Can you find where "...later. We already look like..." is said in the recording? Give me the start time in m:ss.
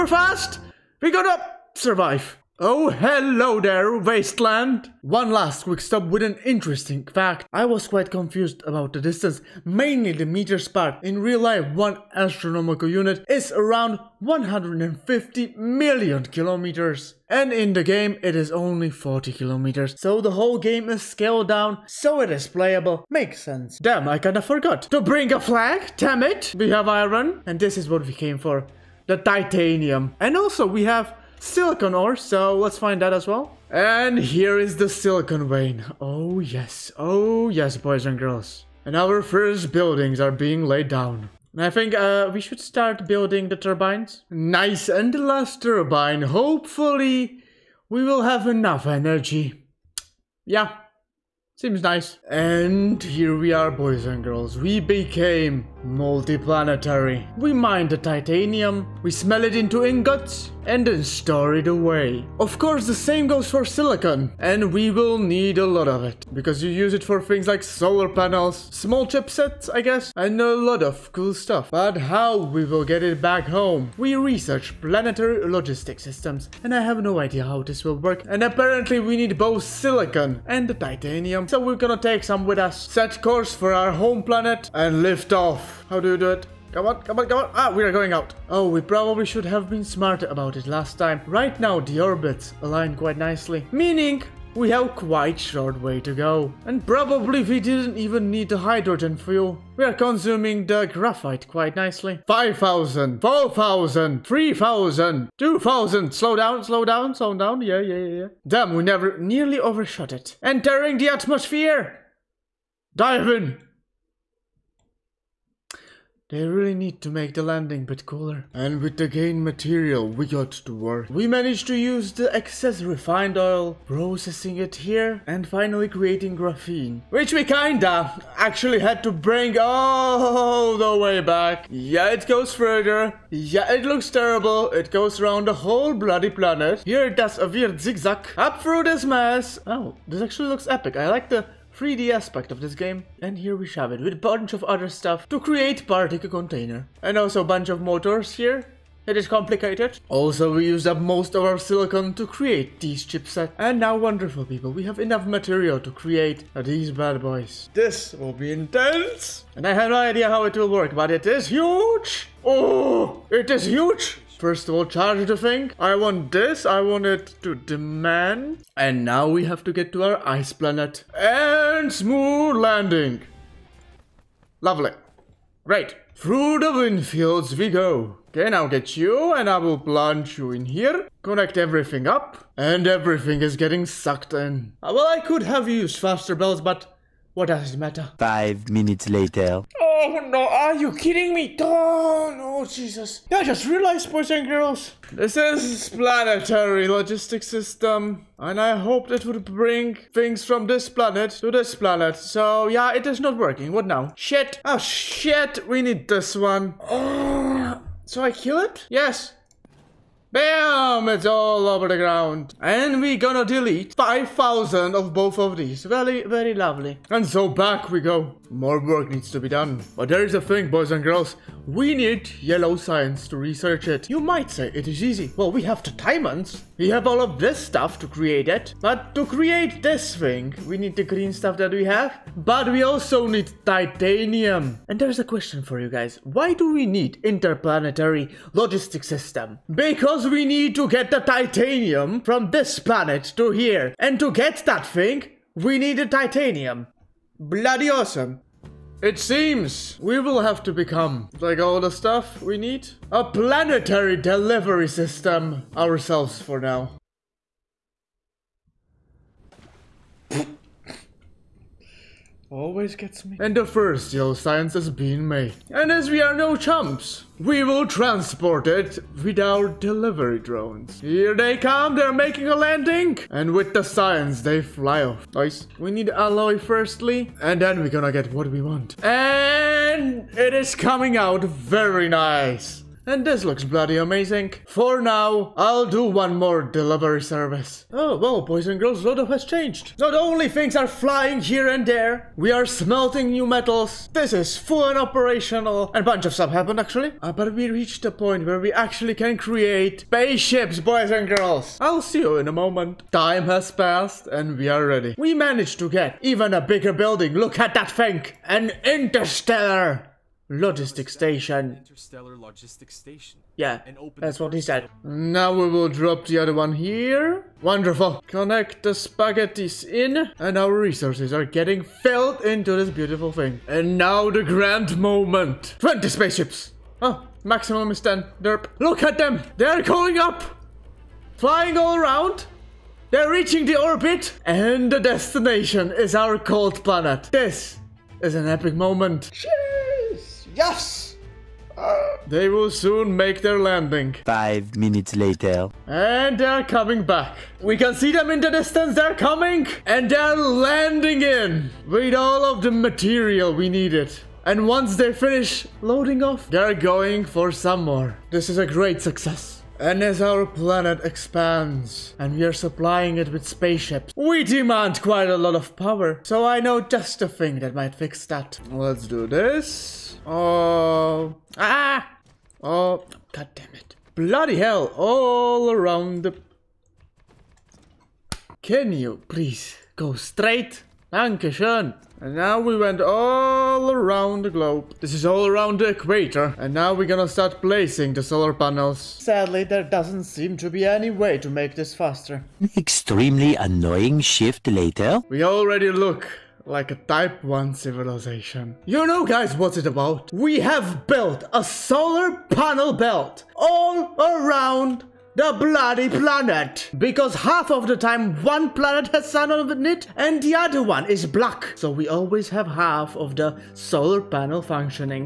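6:34.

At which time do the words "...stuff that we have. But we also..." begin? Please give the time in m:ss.
3:51.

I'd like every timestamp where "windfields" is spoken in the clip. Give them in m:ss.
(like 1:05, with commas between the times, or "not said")
2:56.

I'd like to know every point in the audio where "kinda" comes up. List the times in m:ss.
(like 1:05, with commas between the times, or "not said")
0:24, 2:07.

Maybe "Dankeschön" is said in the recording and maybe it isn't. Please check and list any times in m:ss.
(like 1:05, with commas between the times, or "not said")
6:21.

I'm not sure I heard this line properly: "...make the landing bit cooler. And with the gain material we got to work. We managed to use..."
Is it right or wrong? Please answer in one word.
right.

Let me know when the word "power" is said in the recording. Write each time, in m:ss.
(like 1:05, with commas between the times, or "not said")
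6:05.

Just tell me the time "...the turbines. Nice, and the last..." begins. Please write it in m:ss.
0:43.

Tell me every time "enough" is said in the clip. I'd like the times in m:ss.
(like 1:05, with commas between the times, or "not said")
0:48, 2:35.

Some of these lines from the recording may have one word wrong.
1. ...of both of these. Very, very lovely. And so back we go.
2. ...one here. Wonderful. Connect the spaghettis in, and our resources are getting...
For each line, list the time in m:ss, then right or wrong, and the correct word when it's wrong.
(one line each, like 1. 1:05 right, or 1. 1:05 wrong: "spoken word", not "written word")
1. 3:34 right
2. 5:16 right.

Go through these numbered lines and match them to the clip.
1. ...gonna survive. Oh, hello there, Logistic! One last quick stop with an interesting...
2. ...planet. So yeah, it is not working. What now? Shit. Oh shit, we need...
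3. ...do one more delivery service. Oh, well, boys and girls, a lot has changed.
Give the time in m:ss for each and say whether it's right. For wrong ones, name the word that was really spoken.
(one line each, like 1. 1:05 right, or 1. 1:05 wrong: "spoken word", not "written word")
1. 0:01 wrong: "Wasteland", not "Logistic"
2. 3:21 right
3. 4:45 right.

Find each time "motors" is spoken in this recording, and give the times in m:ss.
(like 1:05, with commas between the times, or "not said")
2:27.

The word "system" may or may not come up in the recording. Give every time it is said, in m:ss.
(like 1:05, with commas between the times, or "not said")
1:15, 3:17, 3:59, 4:14.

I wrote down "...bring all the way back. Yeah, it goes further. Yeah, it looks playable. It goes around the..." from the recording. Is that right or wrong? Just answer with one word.
wrong.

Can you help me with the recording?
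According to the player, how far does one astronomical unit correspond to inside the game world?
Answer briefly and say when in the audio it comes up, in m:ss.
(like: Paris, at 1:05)
40 kilometers, at 0:18.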